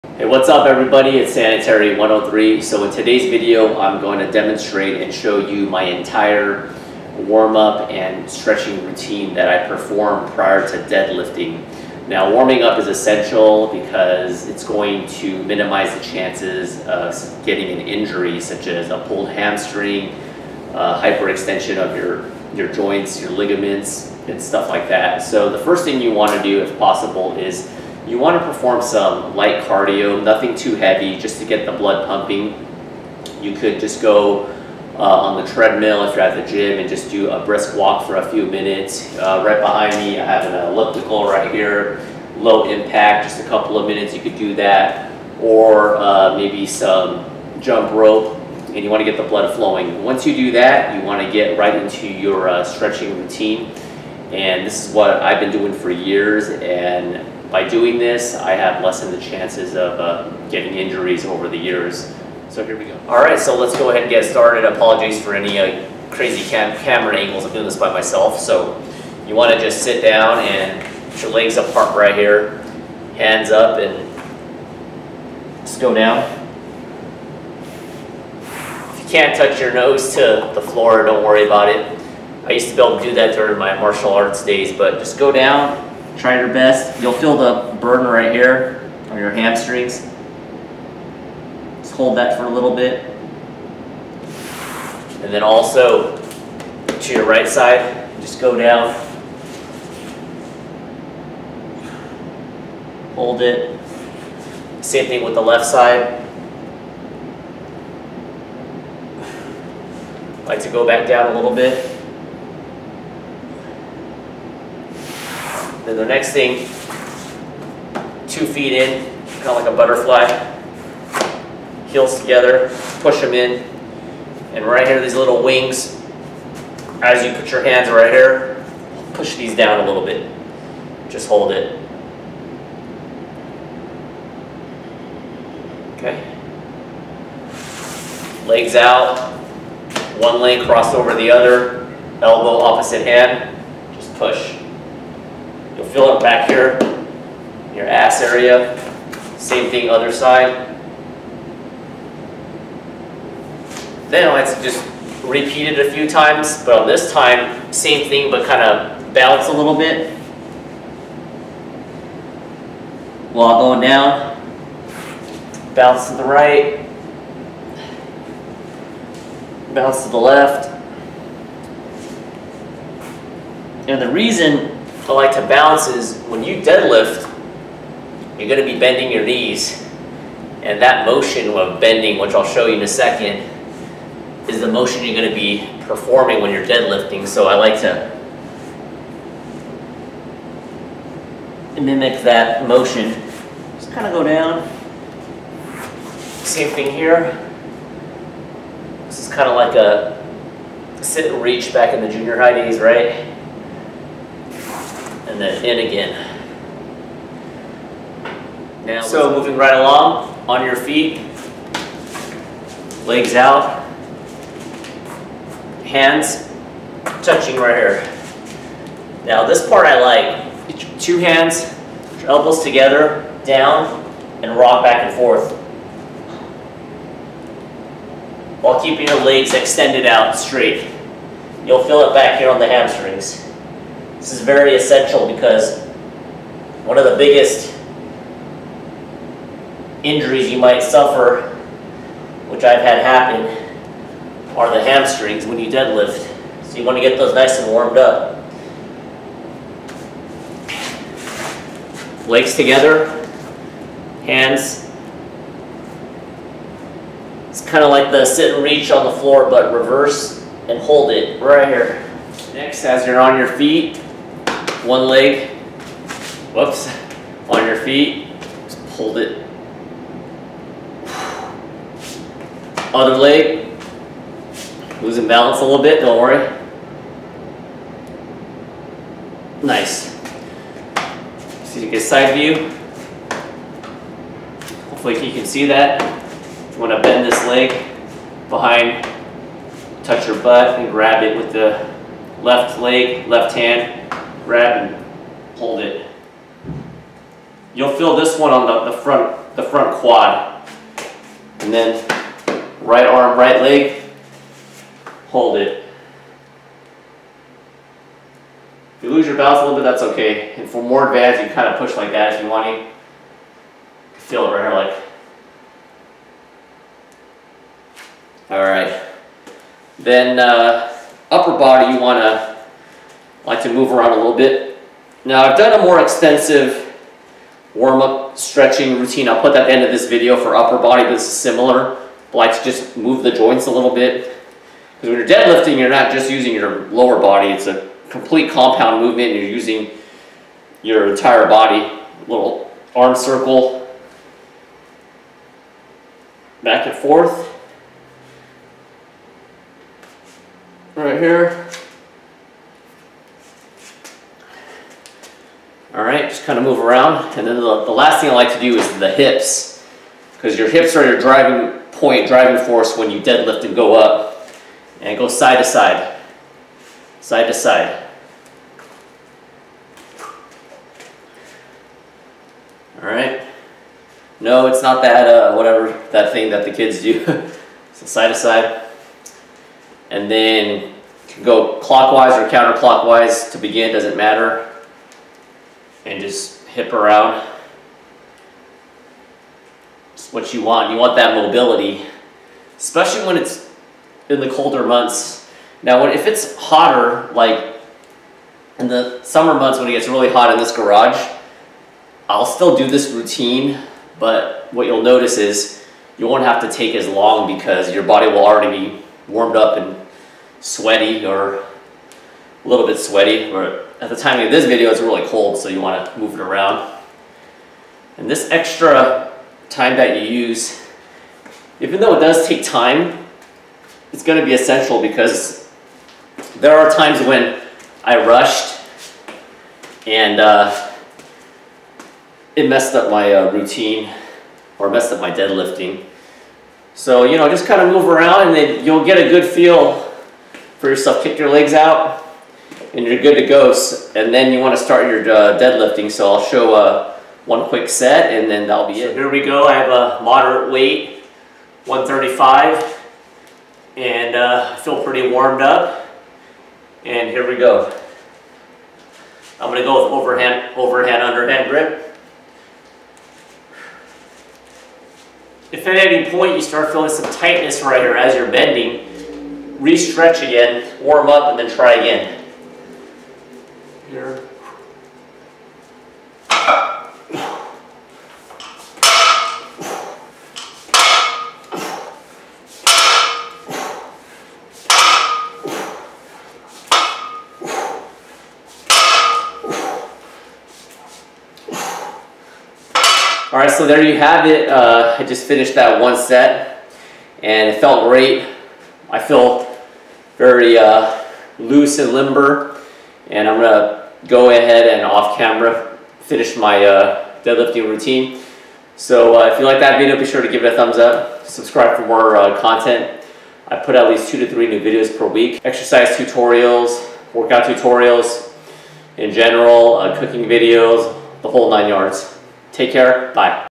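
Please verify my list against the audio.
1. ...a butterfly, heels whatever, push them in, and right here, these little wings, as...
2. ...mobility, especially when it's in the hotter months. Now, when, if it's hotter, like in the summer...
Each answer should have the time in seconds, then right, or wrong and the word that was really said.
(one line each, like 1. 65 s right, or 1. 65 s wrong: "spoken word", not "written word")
1. 119 s wrong: "together", not "whatever"
2. 391 s wrong: "colder", not "hotter".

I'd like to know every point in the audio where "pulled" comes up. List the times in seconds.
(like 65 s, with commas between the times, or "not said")
19 s, 268 s.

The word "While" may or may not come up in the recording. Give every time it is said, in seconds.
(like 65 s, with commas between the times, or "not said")
163 s, 228 s.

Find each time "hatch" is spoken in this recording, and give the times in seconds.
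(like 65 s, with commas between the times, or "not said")
not said.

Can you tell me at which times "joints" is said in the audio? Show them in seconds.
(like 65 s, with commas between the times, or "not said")
22 s, 333 s.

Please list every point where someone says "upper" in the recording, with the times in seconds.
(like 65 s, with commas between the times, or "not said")
321 s, 330 s.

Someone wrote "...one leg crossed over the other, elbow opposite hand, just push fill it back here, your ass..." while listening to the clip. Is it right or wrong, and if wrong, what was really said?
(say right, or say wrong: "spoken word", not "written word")
right.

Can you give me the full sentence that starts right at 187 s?
So I like to mimic that motion.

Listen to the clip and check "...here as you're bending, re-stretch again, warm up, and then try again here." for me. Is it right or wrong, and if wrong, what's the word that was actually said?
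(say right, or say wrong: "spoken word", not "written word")
right.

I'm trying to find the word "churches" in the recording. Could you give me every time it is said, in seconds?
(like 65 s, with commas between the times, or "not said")
not said.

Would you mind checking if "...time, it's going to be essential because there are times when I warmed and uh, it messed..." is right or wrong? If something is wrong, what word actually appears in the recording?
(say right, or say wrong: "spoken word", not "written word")
wrong: "rushed", not "warmed".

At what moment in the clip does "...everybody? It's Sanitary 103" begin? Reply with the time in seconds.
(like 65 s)
0 s.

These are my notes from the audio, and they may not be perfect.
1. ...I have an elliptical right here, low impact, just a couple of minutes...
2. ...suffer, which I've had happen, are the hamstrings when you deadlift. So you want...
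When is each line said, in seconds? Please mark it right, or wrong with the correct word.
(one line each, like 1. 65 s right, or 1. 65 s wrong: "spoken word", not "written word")
1. 40 s right
2. 240 s right.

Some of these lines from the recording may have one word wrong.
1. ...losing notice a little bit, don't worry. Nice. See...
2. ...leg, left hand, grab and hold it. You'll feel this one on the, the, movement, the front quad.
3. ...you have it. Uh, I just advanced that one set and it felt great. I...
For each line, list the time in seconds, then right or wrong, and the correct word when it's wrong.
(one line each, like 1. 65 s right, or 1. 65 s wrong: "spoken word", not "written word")
1. 275 s wrong: "balance", not "notice"
2. 292 s wrong: "front", not "movement"
3. 494 s wrong: "finished", not "advanced".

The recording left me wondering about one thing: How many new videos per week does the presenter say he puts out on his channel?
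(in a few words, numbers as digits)
2 to 3.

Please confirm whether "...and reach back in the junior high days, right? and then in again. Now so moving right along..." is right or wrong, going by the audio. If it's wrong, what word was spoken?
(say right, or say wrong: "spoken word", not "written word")
right.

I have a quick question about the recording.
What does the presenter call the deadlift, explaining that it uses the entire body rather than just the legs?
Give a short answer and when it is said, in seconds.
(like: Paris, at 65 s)
compound movement, at 338 s.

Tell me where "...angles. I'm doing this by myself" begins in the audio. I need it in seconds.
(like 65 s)
67 s.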